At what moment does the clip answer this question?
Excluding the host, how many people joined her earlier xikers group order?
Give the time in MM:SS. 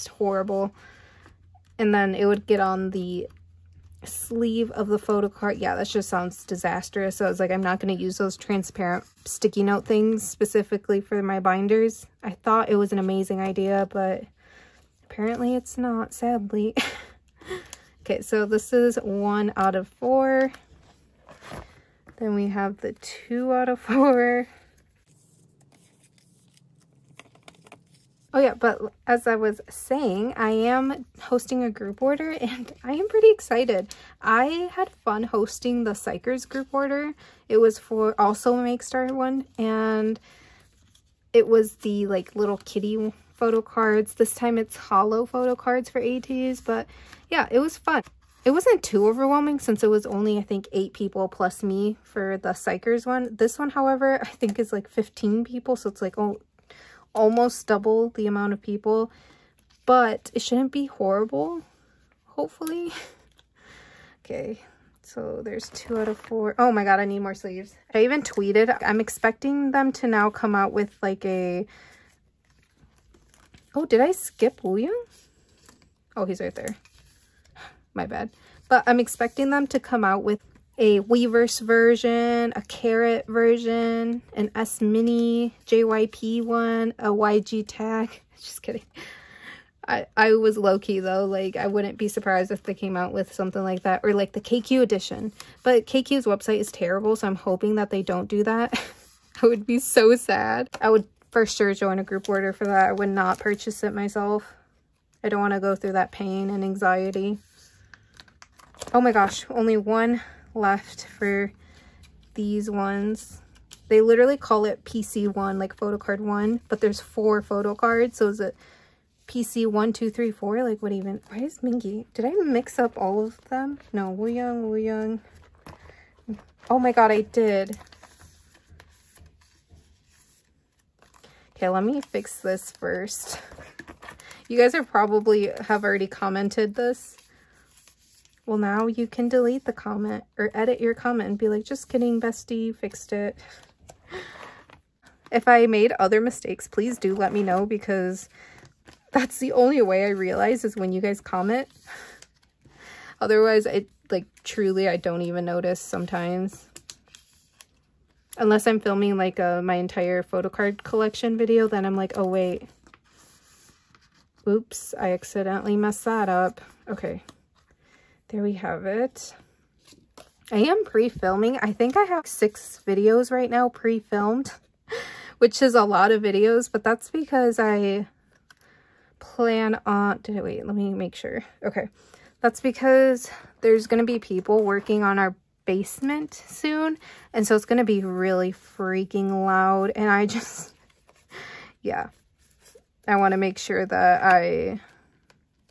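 00:50.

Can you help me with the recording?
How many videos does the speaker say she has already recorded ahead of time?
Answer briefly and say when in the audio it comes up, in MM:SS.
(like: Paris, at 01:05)
6, at 02:52.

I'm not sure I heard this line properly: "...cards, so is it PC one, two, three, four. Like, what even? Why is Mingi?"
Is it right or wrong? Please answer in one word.
right.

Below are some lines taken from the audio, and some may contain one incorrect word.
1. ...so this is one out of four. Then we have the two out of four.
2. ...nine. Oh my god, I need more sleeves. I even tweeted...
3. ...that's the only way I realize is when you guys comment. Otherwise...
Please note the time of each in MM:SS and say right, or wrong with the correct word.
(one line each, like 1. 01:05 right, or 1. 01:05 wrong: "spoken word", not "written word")
1. 00:18 right
2. 01:06 wrong: "four", not "nine"
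3. 02:29 right.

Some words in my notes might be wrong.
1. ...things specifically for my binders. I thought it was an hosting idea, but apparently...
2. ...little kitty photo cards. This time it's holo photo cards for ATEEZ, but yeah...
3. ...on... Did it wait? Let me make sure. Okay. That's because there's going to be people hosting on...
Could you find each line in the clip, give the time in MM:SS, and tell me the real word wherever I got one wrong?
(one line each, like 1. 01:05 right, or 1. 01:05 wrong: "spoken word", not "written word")
1. 00:09 wrong: "amazing", not "hosting"
2. 00:42 right
3. 02:59 wrong: "working", not "hosting".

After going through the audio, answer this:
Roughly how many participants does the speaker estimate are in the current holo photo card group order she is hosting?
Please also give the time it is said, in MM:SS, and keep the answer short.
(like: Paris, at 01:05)
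15, at 00:54.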